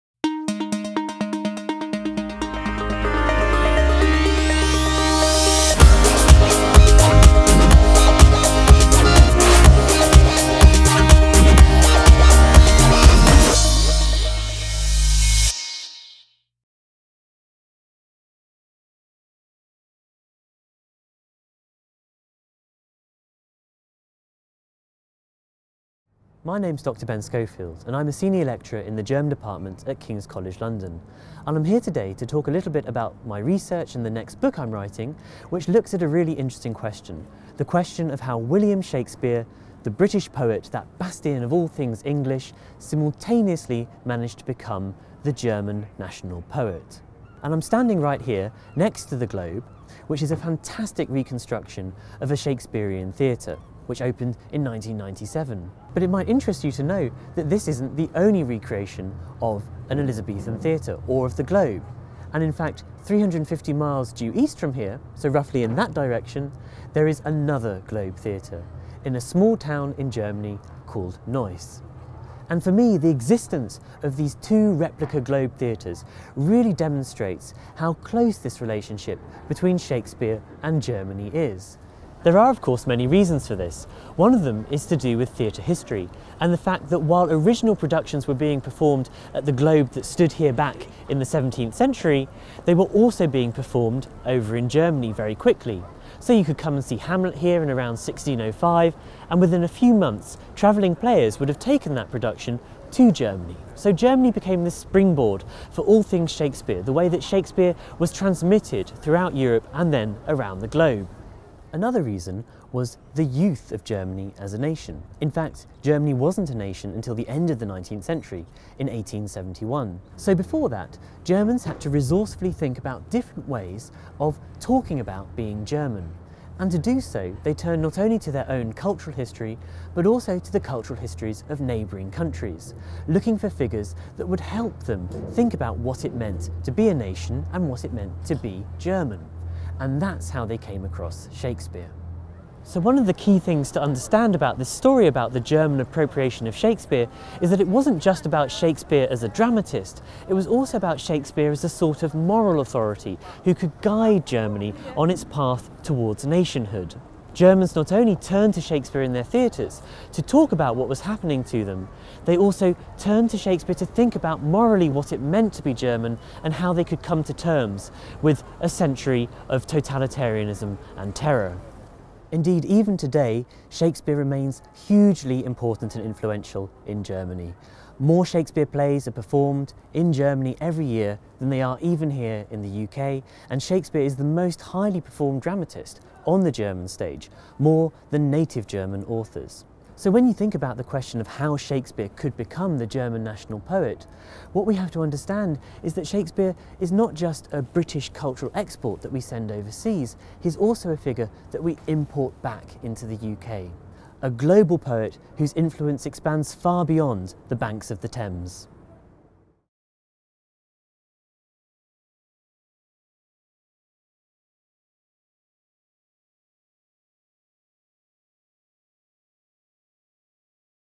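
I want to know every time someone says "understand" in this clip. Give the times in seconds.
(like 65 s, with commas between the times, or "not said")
143 s, 195 s.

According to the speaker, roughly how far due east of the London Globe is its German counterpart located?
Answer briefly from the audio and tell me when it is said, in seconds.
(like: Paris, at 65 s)
350 miles, at 63 s.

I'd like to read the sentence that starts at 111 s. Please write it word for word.
Another reason was the youth of Germany as a nation.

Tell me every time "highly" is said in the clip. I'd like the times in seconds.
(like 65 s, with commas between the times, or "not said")
184 s.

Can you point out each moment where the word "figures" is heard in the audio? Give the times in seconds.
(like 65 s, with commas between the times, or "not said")
133 s, 200 s.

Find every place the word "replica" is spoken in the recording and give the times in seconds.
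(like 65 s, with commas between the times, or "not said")
74 s.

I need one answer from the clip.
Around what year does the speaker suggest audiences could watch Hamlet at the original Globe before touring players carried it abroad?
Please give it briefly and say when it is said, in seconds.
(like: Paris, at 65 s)
1605, at 97 s.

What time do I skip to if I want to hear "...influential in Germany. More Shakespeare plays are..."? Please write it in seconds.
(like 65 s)
176 s.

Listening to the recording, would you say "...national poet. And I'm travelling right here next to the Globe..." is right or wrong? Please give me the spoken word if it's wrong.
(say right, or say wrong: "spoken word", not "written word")
wrong: "standing", not "travelling".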